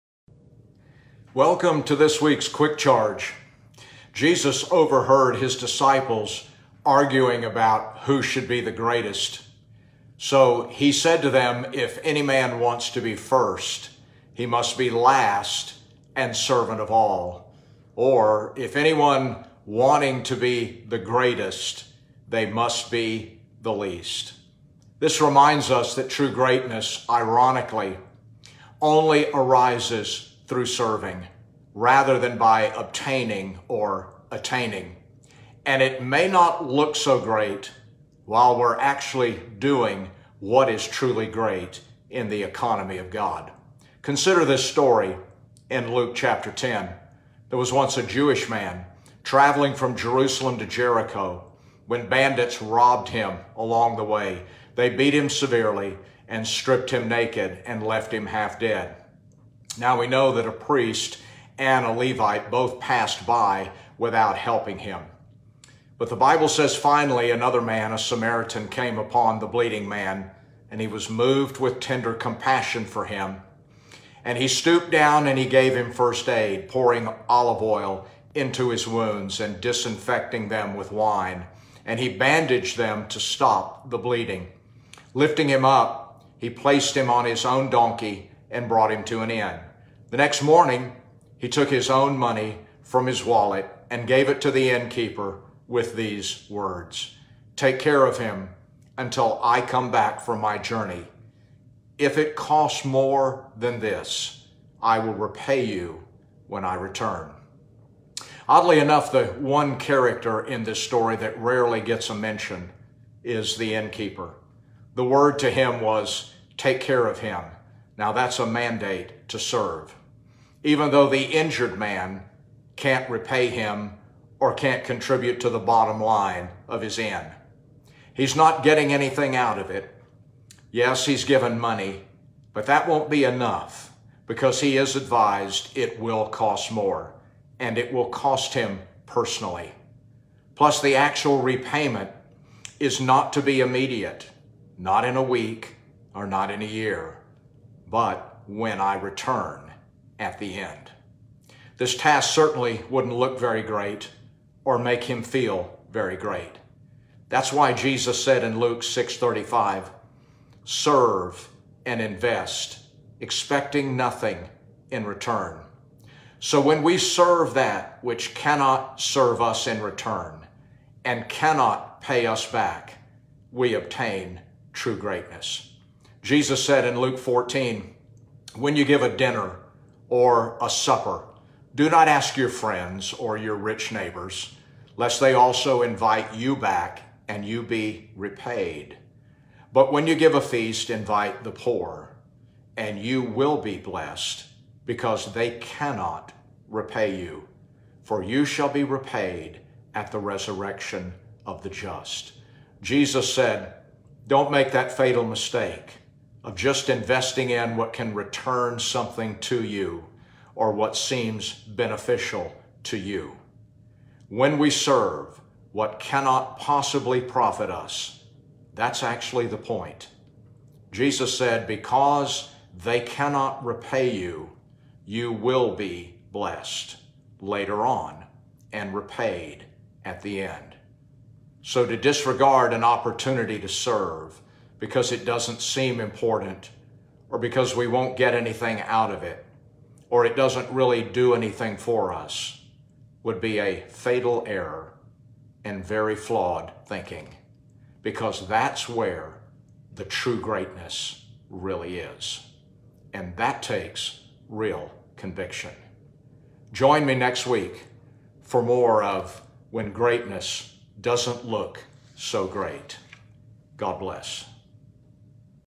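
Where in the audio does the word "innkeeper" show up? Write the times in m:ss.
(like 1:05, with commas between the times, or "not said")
1:34, 1:53.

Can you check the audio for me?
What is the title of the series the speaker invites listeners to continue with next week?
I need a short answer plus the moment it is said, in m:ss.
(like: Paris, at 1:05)
When Greatness Doesn't Look So Great, at 4:19.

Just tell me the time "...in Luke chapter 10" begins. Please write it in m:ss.
0:45.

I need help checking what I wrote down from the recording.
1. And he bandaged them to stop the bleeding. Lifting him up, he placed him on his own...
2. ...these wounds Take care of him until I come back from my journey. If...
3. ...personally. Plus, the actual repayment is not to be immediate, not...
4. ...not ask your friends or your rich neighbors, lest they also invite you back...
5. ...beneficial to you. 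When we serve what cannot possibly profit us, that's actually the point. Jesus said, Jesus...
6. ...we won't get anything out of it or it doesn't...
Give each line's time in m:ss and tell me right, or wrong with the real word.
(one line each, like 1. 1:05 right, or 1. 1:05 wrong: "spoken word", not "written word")
1. 1:21 right
2. 1:35 wrong: "words", not "wounds"
3. 2:19 right
4. 3:01 right
5. 3:31 wrong: "Because", not "Jesus"
6. 3:57 right.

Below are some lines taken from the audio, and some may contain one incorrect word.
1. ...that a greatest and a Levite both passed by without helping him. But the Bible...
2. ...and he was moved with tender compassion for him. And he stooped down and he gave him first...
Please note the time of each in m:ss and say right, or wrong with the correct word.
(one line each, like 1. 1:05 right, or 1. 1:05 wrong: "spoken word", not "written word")
1. 1:00 wrong: "priest", not "greatest"
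2. 1:10 right.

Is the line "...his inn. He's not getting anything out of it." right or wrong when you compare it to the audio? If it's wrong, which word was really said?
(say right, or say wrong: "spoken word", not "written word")
right.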